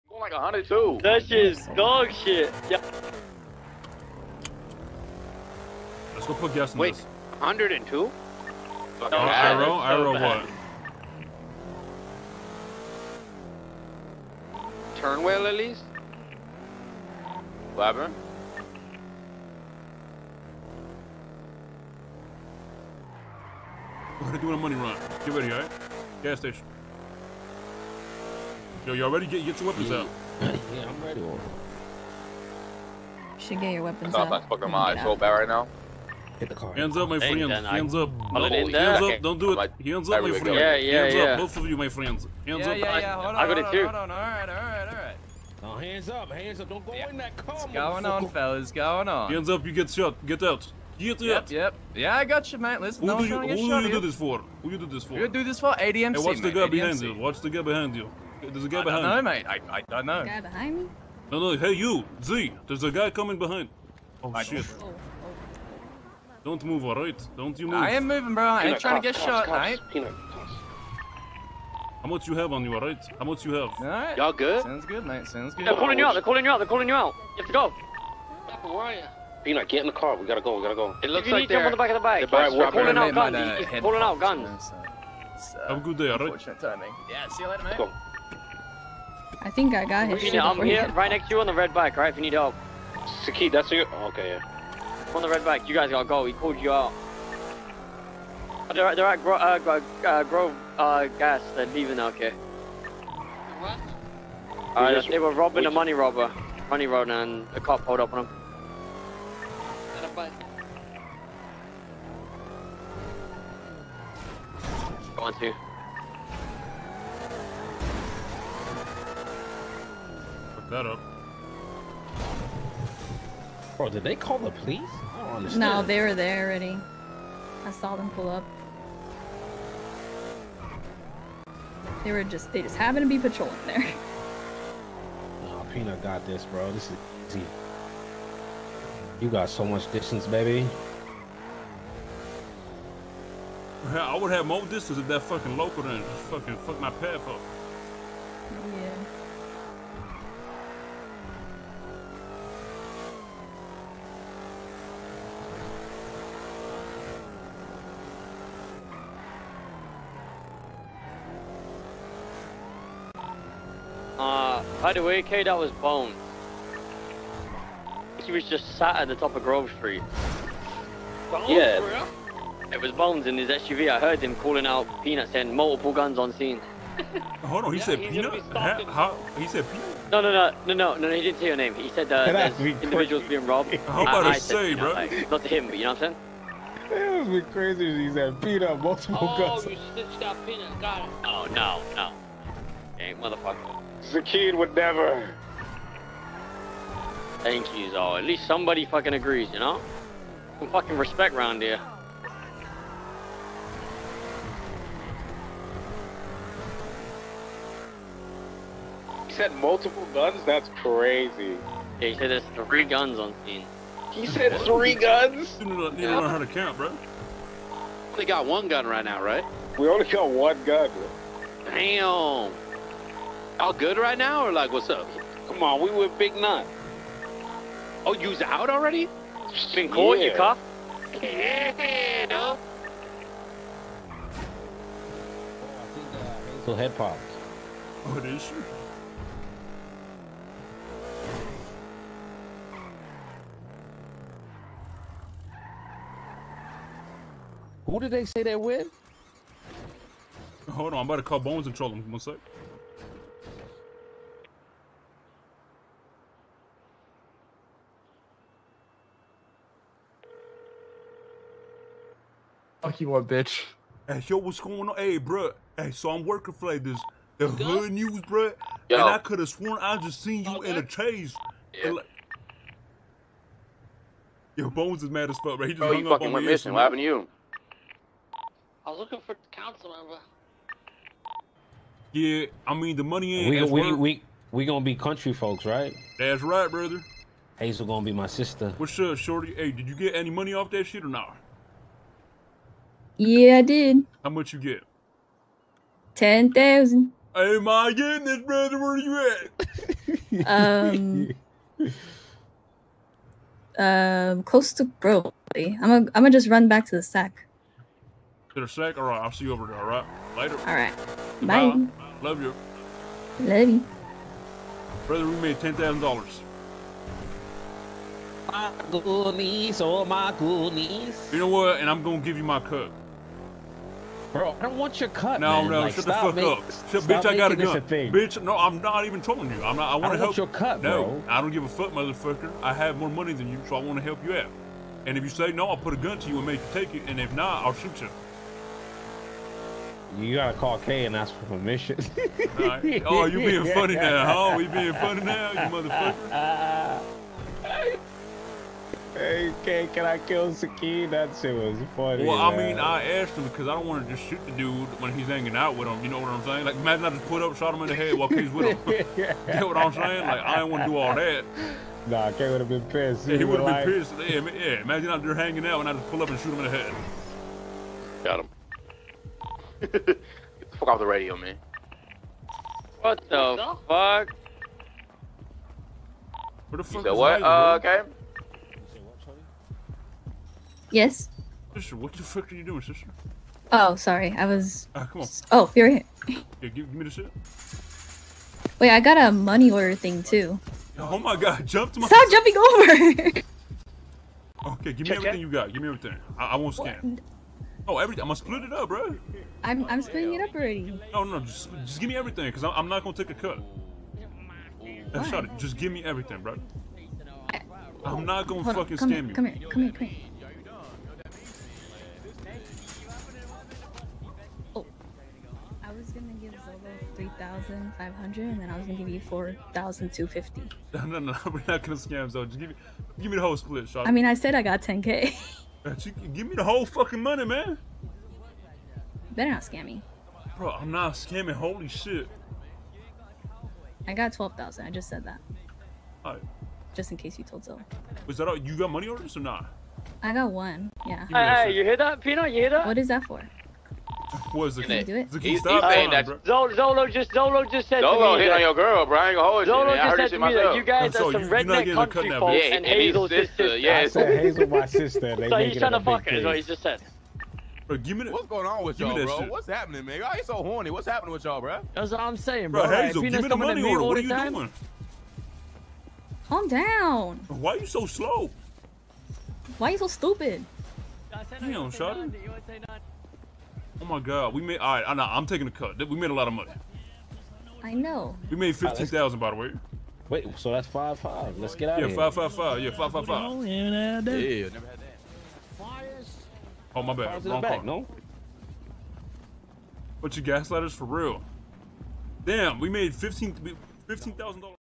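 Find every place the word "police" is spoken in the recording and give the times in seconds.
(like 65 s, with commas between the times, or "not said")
124 s.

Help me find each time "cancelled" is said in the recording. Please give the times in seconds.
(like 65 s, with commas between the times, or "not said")
not said.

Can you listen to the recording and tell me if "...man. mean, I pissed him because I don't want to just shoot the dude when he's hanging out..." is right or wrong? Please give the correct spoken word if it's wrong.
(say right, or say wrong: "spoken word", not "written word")
wrong: "asked", not "pissed".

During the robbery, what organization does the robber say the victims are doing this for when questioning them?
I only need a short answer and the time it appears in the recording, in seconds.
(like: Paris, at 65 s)
ADMC, at 55 s.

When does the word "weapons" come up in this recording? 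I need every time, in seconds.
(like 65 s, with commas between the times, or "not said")
29 s, 33 s.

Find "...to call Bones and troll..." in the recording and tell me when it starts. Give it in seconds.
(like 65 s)
251 s.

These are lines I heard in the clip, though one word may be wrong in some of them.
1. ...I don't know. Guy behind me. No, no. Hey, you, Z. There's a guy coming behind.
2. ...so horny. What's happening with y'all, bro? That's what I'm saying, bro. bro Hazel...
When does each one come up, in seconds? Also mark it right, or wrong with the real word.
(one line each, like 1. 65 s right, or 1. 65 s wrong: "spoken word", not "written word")
1. 59 s right
2. 460 s right.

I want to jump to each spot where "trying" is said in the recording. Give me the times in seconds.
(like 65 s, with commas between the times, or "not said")
68 s, 455 s.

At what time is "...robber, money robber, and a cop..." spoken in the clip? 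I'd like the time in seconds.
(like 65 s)
105 s.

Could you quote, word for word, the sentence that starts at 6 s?
Let's go put gas in Wait, this.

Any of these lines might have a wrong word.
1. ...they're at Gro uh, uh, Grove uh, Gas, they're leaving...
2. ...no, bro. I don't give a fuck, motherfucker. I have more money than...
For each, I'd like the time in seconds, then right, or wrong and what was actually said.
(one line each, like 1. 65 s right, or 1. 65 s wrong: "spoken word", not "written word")
1. 98 s right
2. 330 s right.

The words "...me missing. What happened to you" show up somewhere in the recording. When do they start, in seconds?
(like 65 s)
276 s.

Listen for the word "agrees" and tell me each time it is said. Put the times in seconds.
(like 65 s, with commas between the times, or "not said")
199 s.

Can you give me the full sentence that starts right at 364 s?
Yeah, yeah, imagine out there hanging out and I just pull up and shoot him in the head.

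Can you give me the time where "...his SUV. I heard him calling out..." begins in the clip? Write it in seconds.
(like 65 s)
173 s.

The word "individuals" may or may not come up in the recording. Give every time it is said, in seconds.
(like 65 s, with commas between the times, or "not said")
182 s.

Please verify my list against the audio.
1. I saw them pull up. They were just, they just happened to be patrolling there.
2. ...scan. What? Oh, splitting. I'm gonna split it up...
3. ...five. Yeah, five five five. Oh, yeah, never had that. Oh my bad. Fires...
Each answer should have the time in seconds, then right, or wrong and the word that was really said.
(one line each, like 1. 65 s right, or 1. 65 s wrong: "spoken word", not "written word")
1. 127 s right
2. 396 s wrong: "everything", not "splitting"
3. 482 s right.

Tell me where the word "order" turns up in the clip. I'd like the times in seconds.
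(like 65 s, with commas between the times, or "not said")
389 s, 439 s, 463 s.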